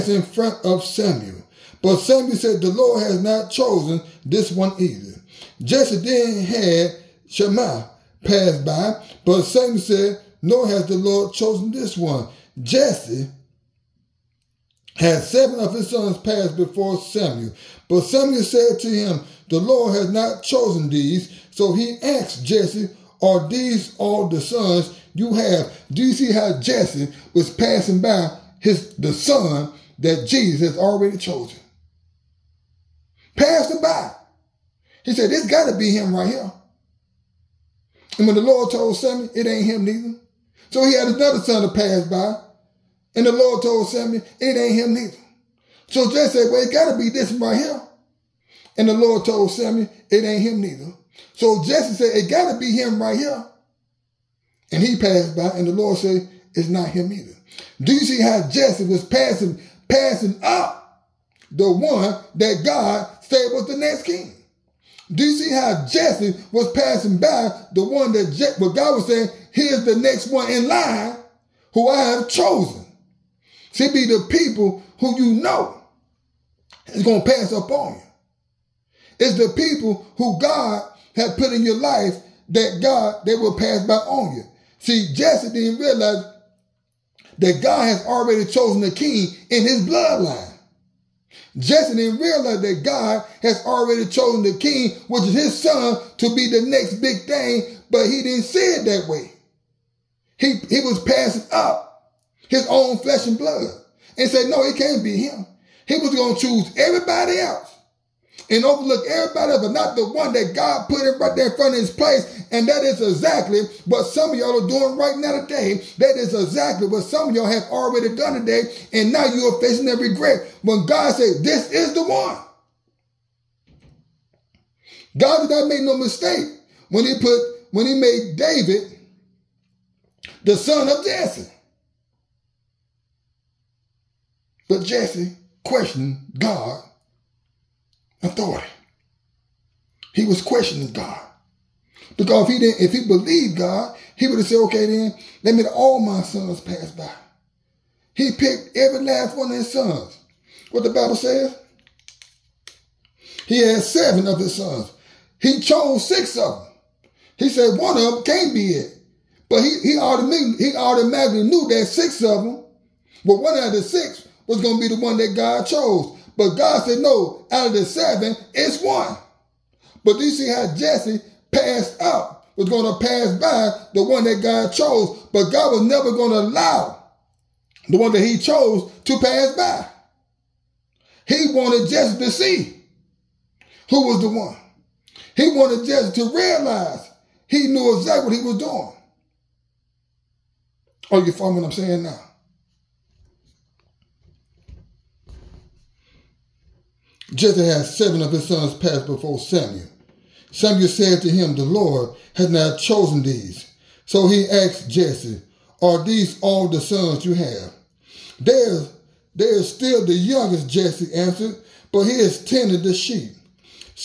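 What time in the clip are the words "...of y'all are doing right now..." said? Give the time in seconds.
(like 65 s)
114 s.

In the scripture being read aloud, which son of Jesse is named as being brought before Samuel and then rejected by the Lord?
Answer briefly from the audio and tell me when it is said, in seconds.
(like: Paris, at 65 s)
Shammah, at 7 s.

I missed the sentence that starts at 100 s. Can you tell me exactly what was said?
He, he was passing up his own flesh and blood and said, no, it can't be him.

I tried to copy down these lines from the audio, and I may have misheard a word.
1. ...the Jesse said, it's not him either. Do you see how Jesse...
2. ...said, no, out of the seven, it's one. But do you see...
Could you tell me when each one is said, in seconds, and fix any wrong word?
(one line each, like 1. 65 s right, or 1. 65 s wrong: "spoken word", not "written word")
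1. 55 s wrong: "Lord", not "Jesse"
2. 166 s right.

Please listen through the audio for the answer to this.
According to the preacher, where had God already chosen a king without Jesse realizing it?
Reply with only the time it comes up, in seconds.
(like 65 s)
89 s.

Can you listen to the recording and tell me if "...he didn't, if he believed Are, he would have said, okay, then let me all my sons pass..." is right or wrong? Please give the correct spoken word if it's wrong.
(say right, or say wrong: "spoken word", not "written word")
wrong: "God", not "Are".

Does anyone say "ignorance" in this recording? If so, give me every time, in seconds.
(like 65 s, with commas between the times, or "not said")
not said.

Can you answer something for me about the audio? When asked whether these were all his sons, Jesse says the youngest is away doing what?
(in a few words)
tending the sheep.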